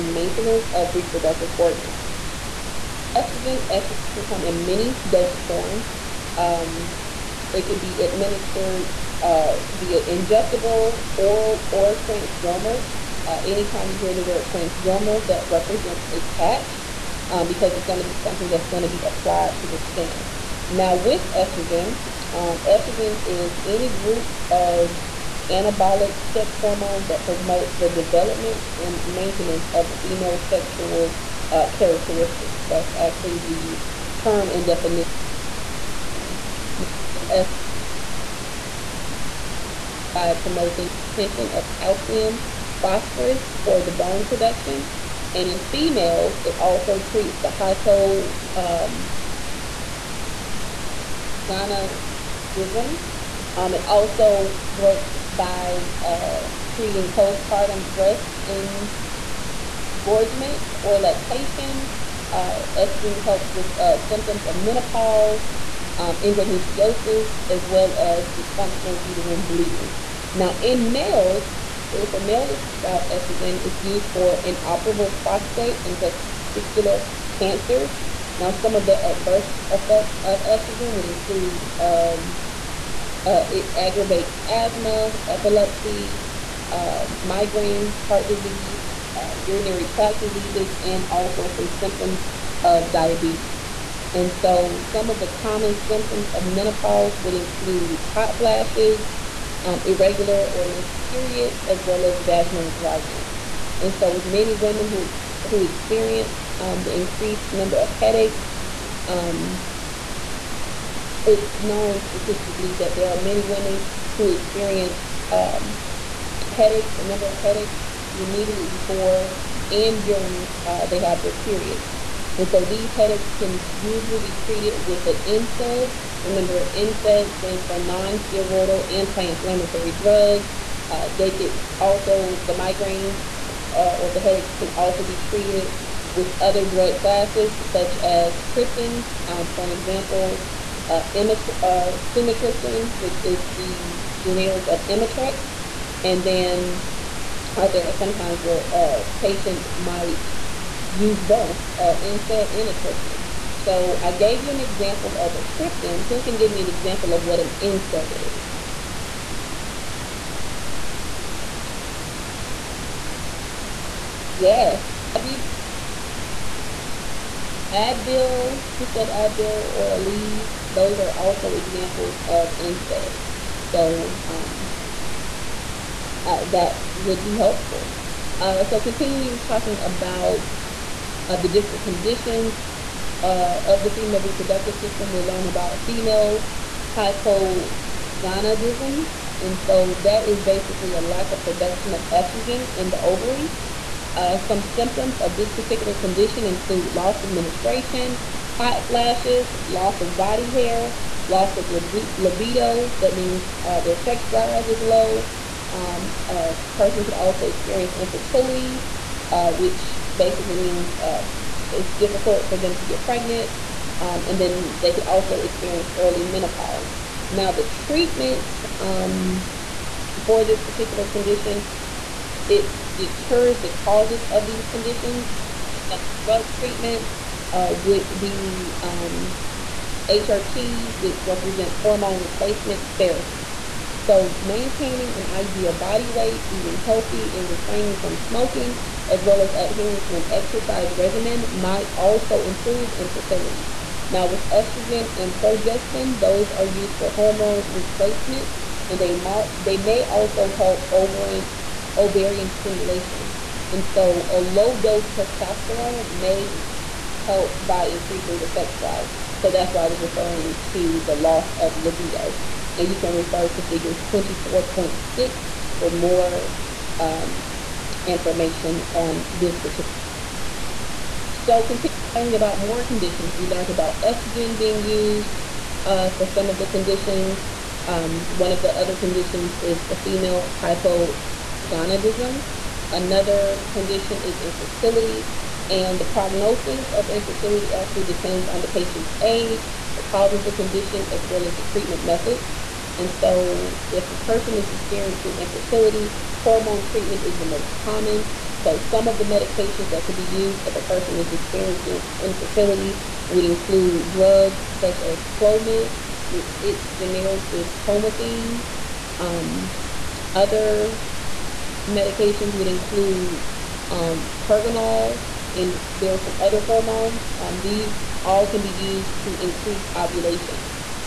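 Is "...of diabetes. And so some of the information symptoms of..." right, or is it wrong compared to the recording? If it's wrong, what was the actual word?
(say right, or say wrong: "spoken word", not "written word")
wrong: "common", not "information".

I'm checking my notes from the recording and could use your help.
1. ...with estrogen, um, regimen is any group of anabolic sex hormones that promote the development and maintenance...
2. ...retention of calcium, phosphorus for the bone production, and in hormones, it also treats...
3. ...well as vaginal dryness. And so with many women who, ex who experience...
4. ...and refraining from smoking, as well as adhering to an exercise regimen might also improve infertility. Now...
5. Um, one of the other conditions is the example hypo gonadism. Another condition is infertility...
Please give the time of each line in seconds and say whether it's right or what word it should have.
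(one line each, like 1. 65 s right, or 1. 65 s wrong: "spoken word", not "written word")
1. 20 s wrong: "estrogen", not "regimen"
2. 41 s wrong: "females", not "hormones"
3. 101 s right
4. 237 s right
5. 277 s wrong: "female", not "example".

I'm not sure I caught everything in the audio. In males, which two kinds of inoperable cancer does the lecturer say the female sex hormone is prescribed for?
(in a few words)
prostate and testicular.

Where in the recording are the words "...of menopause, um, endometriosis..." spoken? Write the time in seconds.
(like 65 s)
64 s.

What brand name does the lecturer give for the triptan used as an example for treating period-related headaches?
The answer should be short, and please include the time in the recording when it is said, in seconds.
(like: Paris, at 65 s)
Imitrex, at 144 s.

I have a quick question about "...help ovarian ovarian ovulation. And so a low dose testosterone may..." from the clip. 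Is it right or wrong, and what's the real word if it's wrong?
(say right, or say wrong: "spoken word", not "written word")
wrong: "stimulation", not "ovulation".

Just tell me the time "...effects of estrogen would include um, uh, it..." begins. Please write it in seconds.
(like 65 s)
79 s.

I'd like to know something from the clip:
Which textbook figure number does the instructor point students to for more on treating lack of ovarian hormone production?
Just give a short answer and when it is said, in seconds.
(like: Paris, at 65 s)
24.6, at 263 s.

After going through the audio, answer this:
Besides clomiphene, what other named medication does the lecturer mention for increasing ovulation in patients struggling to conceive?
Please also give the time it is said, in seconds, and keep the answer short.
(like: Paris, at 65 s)
Pergonal, at 314 s.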